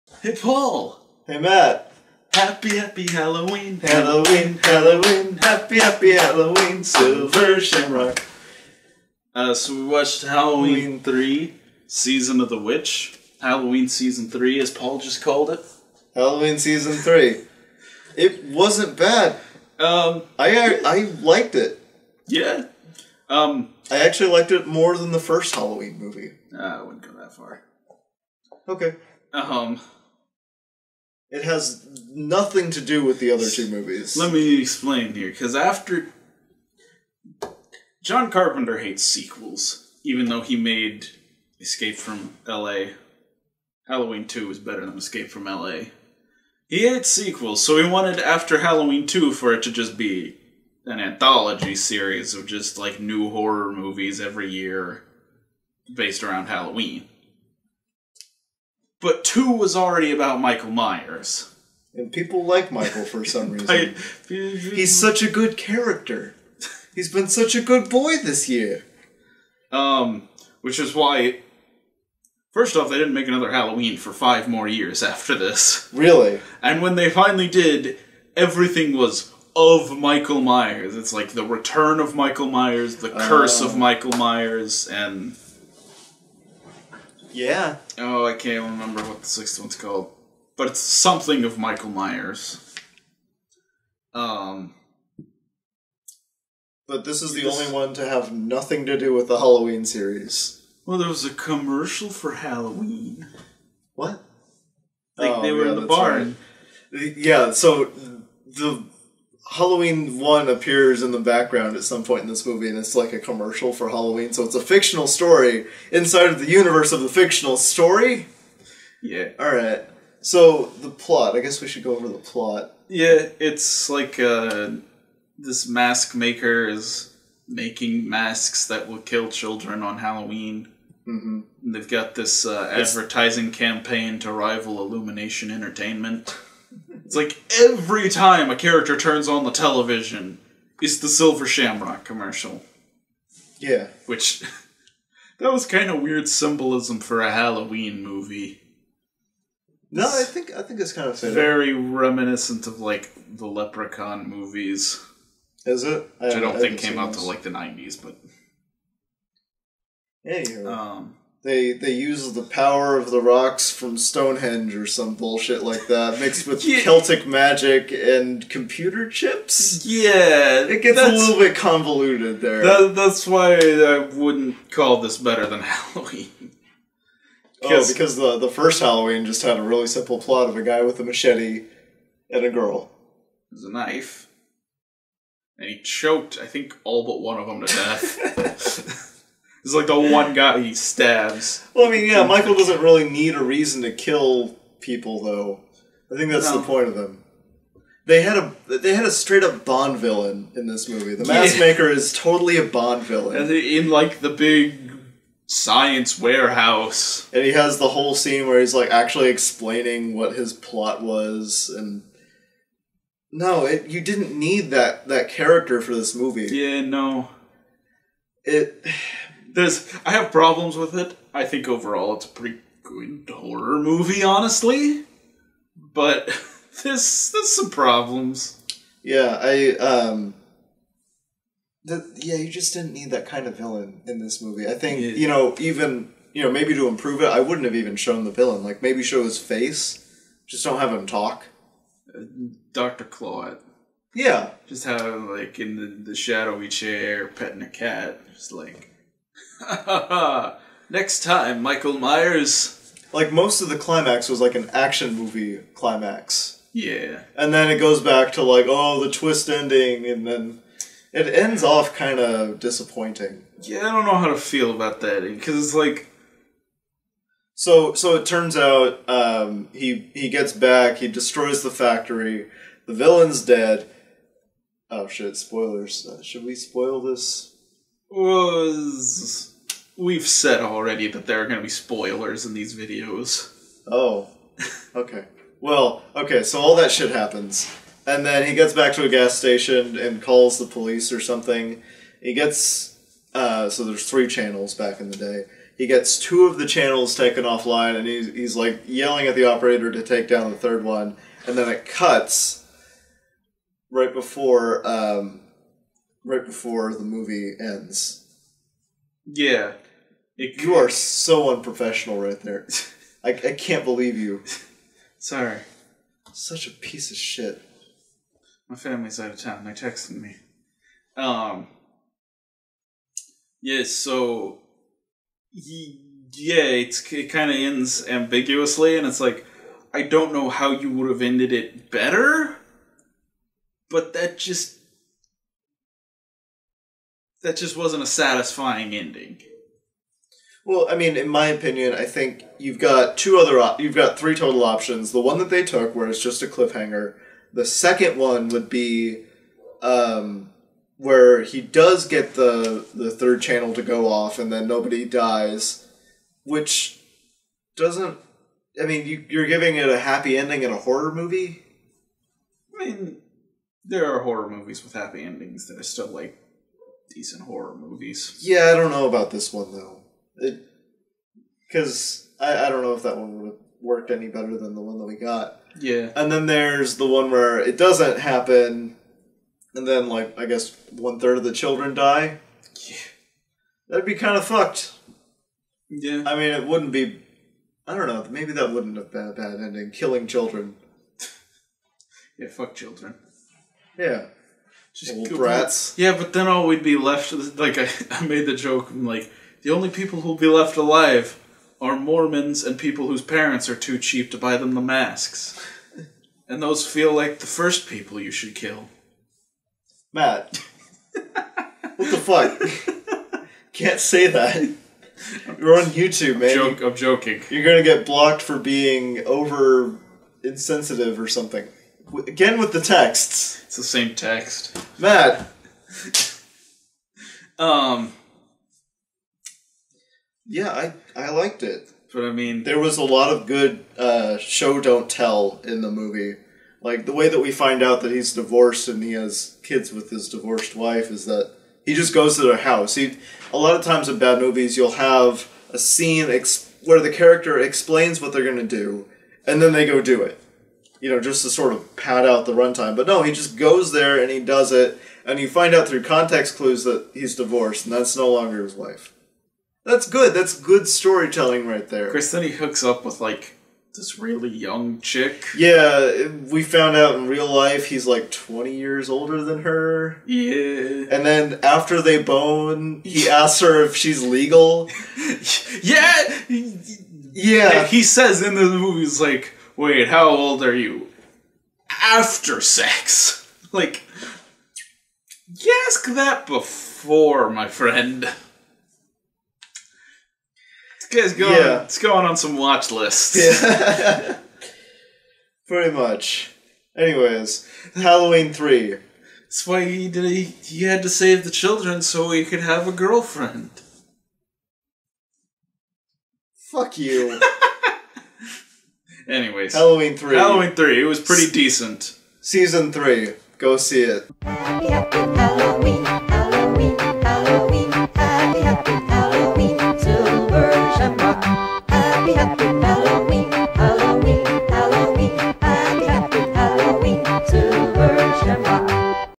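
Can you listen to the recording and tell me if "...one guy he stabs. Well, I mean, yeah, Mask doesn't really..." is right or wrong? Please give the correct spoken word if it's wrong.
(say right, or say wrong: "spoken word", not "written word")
wrong: "Michael", not "Mask".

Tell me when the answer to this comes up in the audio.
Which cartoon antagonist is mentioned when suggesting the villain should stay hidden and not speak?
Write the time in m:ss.
4:02.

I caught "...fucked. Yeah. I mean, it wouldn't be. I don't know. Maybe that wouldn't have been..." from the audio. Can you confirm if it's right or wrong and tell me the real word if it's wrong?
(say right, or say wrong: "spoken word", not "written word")
right.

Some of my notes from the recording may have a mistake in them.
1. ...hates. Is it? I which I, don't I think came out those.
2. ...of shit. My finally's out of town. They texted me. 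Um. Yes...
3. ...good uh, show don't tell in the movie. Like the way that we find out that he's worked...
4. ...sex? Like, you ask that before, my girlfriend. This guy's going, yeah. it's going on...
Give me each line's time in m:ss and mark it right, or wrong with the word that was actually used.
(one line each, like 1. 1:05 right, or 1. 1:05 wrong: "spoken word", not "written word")
1. 2:34 wrong: "movies", not "hates"
2. 5:17 wrong: "family", not "finally"
3. 7:13 wrong: "divorced", not "worked"
4. 8:02 wrong: "friend", not "girlfriend".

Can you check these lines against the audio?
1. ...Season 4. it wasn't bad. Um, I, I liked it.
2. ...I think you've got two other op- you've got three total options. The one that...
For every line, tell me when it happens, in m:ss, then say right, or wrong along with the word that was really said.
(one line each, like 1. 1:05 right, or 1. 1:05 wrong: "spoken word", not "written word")
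1. 0:16 wrong: "3", not "4"
2. 5:41 right.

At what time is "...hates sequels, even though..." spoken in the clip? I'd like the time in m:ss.
0:38.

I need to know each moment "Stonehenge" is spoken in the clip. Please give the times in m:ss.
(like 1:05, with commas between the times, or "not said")
2:43.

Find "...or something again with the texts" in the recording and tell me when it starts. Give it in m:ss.
7:01.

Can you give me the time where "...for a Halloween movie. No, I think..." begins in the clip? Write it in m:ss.
2:27.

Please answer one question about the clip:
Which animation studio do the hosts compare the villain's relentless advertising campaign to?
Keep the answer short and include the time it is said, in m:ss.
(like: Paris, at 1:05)
Illumination Entertainment, at 2:14.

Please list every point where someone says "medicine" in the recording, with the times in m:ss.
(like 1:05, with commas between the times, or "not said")
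not said.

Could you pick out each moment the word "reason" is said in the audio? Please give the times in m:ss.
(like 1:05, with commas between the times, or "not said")
1:03, 3:13.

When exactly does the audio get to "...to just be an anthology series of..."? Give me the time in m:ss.
0:49.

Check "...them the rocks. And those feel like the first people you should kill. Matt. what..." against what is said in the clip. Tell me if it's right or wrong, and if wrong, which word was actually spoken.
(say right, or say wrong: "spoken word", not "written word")
wrong: "masks", not "rocks".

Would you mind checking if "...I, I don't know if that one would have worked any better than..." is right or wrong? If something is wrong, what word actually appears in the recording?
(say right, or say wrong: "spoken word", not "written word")
right.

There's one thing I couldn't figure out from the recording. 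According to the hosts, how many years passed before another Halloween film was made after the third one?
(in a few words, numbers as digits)
5.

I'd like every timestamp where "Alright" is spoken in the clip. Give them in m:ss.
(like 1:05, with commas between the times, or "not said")
1:59.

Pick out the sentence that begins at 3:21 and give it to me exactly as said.
The Mask Maker is totally a Bond villain.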